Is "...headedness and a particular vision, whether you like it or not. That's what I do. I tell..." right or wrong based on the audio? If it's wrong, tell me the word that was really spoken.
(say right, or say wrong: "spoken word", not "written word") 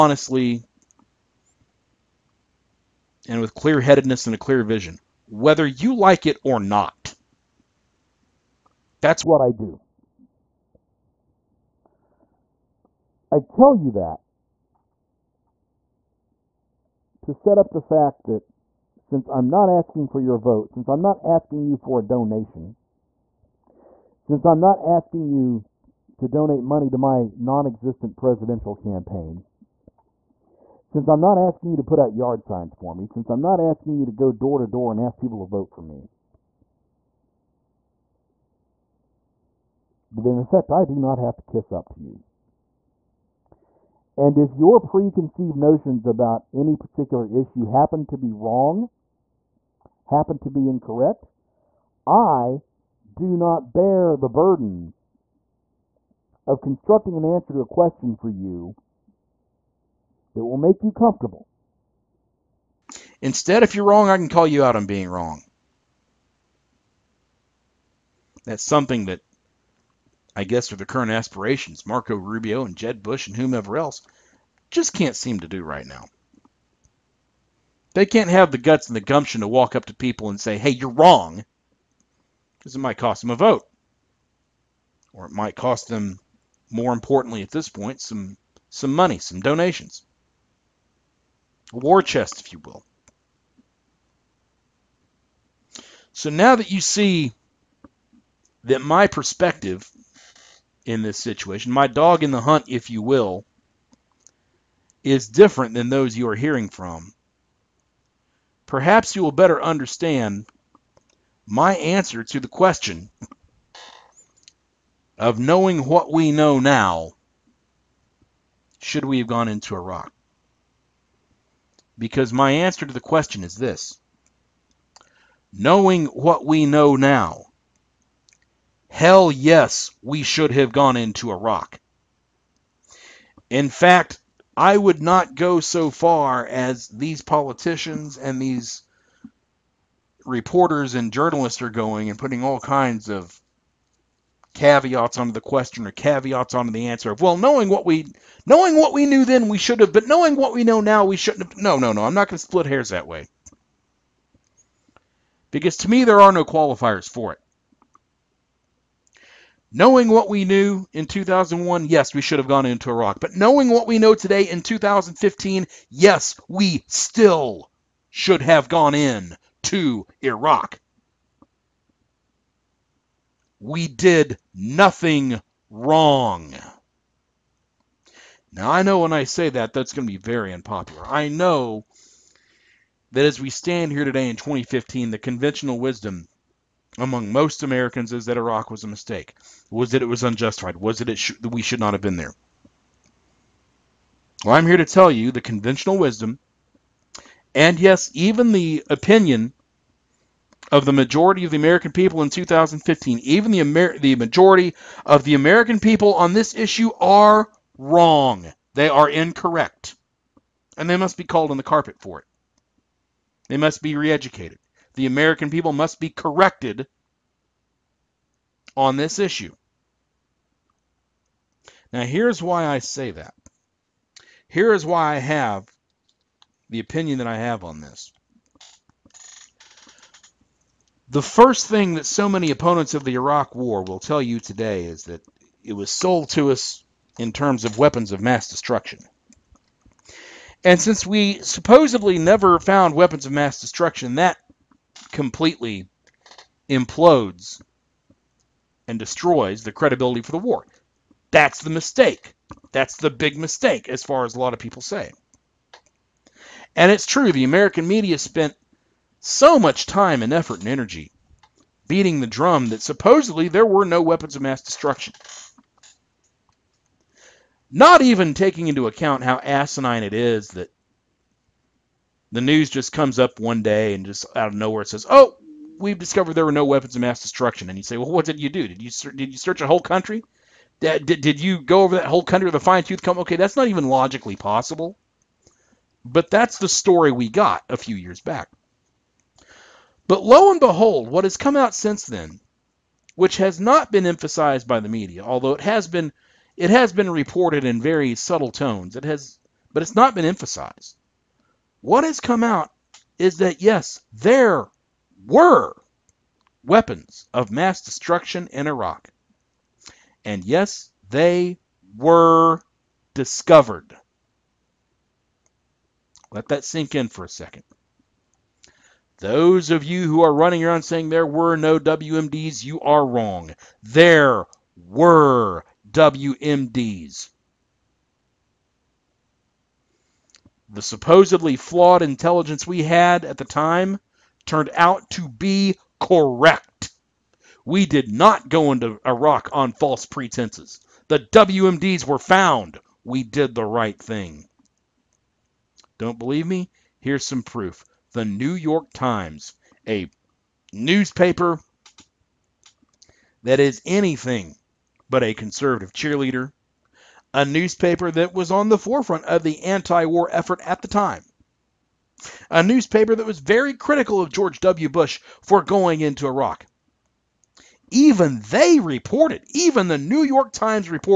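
wrong: "clear", not "particular".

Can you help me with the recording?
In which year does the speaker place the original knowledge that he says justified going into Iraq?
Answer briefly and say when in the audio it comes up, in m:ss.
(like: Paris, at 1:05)
2001, at 2:41.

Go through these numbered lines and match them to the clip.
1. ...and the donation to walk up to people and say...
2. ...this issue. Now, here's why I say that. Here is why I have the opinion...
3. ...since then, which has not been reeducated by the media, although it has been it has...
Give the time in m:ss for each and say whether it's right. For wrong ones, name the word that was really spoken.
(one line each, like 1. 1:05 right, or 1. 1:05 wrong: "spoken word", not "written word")
1. 1:18 wrong: "gumption", not "donation"
2. 3:38 right
3. 4:51 wrong: "emphasized", not "reeducated".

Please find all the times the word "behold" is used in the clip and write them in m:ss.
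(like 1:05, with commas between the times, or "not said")
4:50.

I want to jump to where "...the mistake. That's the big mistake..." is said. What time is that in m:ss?
4:11.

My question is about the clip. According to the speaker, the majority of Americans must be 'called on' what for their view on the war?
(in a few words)
the carpet.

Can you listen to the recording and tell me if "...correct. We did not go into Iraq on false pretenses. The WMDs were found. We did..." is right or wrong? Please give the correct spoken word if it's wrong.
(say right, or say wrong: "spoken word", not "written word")
right.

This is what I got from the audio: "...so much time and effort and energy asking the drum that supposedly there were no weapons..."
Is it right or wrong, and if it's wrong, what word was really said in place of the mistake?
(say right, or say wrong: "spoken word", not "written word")
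wrong: "beating", not "asking".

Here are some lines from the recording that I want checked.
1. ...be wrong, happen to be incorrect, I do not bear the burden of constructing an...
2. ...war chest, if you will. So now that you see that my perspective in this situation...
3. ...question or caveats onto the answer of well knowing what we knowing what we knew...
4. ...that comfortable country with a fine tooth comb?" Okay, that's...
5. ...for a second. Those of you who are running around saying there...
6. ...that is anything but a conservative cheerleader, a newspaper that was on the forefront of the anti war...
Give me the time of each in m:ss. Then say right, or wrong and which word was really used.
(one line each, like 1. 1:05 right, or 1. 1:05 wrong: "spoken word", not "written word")
1. 0:48 right
2. 1:31 right
3. 2:25 right
4. 4:41 wrong: "whole", not "comfortable"
5. 5:17 right
6. 5:53 right.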